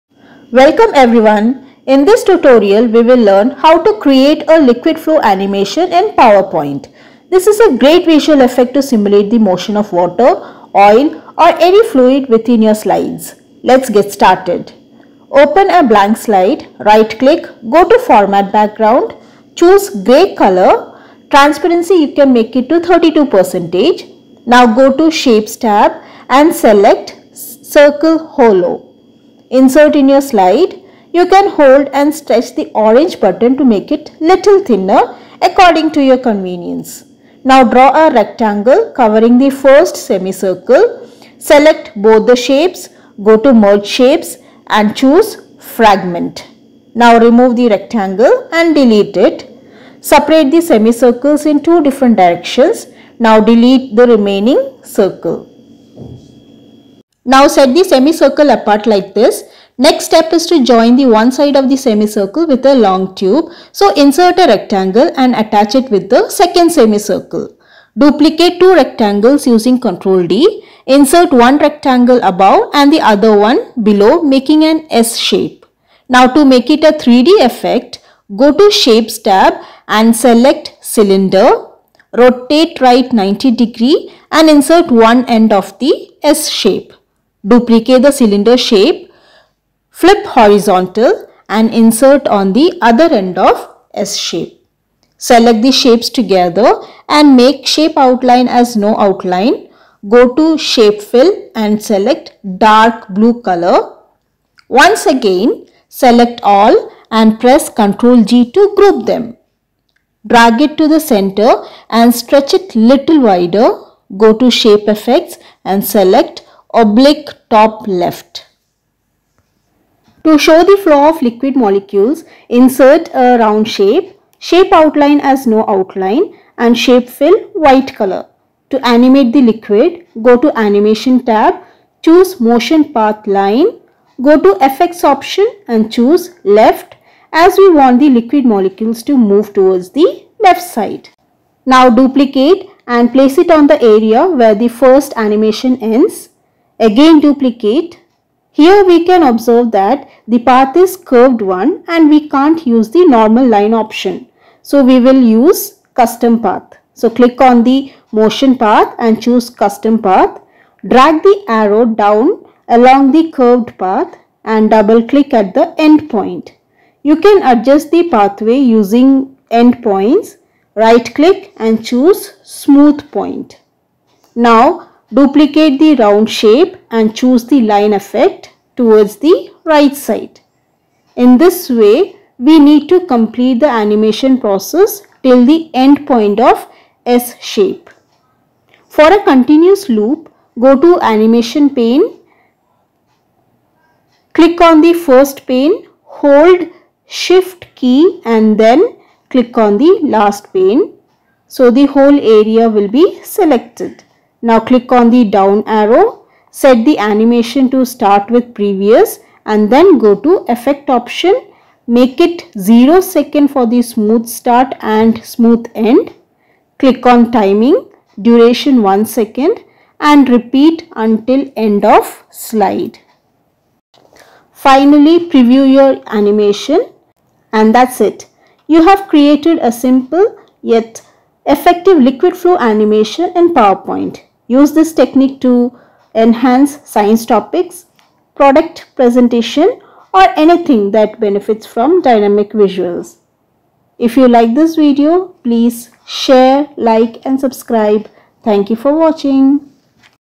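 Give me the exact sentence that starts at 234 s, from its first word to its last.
Use this technique to enhance science topics, product presentation or anything that benefits from dynamic visuals.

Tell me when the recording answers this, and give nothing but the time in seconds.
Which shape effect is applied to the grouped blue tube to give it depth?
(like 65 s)
116 s.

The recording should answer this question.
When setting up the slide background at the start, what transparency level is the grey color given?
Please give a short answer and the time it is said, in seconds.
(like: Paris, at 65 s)
32%, at 22 s.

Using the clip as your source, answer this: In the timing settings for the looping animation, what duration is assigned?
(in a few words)
1 second.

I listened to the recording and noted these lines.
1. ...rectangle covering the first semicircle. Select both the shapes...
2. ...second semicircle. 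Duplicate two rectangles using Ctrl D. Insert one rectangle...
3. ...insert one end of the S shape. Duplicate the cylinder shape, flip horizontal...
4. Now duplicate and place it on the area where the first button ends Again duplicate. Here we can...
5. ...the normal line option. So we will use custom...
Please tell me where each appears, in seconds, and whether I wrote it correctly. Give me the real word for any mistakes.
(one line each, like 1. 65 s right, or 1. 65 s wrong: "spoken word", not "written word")
1. 38 s right
2. 66 s right
3. 84 s right
4. 141 s wrong: "animation", not "button"
5. 152 s right.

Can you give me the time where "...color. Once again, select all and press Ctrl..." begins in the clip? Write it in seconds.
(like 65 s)
103 s.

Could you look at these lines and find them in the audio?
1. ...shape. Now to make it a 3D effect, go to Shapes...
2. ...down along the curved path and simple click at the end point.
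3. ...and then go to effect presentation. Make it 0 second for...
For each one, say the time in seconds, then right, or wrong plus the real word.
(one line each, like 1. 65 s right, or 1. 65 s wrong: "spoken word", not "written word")
1. 75 s right
2. 161 s wrong: "double", not "simple"
3. 209 s wrong: "option", not "presentation".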